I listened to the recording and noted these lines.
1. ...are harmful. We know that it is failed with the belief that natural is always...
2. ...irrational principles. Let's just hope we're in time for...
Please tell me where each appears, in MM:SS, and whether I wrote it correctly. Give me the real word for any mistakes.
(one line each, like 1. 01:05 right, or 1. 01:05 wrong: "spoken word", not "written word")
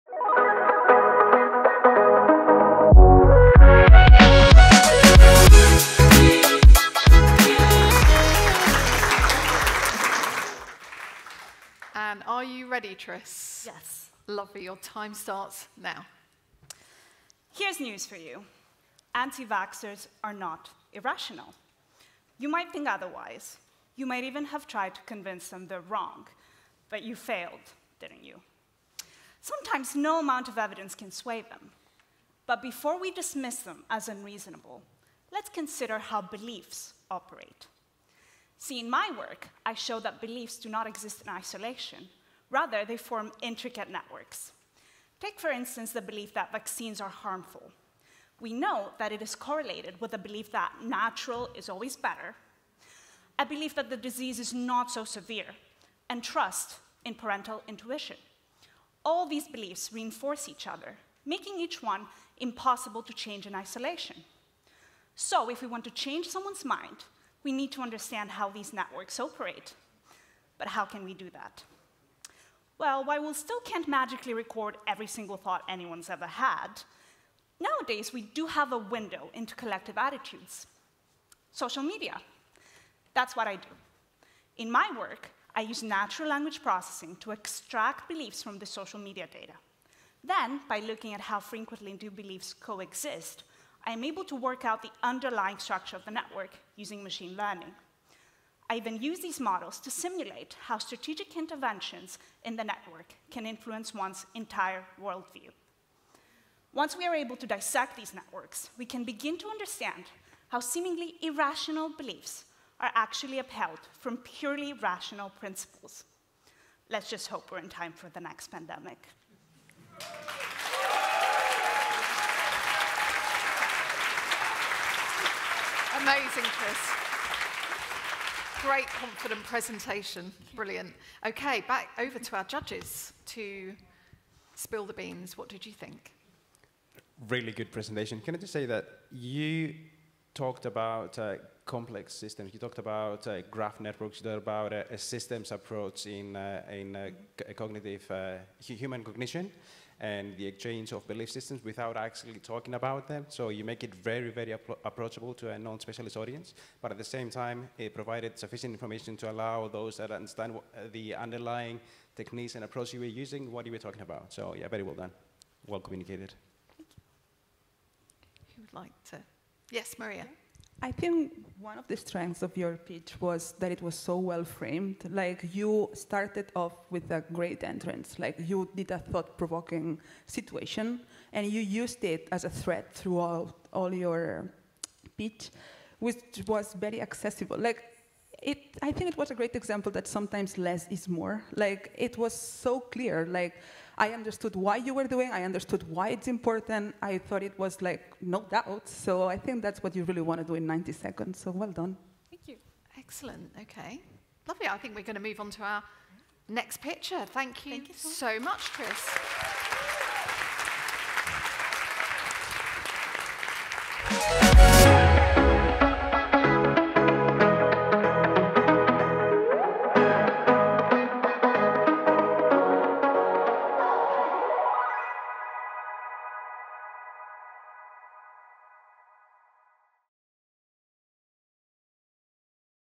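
1. 00:46 wrong: "correlated", not "failed"
2. 01:54 wrong: "rational", not "irrational".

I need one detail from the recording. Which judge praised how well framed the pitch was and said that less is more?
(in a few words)
Maria.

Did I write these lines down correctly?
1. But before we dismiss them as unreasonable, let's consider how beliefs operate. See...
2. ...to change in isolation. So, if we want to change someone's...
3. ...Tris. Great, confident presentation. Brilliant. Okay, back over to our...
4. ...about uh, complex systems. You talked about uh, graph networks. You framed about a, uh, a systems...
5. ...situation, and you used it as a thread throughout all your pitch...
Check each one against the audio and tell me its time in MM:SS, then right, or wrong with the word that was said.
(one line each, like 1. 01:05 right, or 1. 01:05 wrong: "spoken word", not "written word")
1. 00:32 right
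2. 01:03 right
3. 02:06 right
4. 02:20 wrong: "talked", not "framed"
5. 03:00 right.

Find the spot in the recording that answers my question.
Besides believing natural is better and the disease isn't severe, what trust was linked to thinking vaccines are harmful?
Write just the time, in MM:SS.
00:57.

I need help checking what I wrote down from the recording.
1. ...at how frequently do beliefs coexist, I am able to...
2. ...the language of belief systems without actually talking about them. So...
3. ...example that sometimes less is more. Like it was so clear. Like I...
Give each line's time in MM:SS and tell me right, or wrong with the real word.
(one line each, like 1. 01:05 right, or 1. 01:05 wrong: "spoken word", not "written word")
1. 01:31 right
2. 02:30 wrong: "exchange", not "language"
3. 03:09 right.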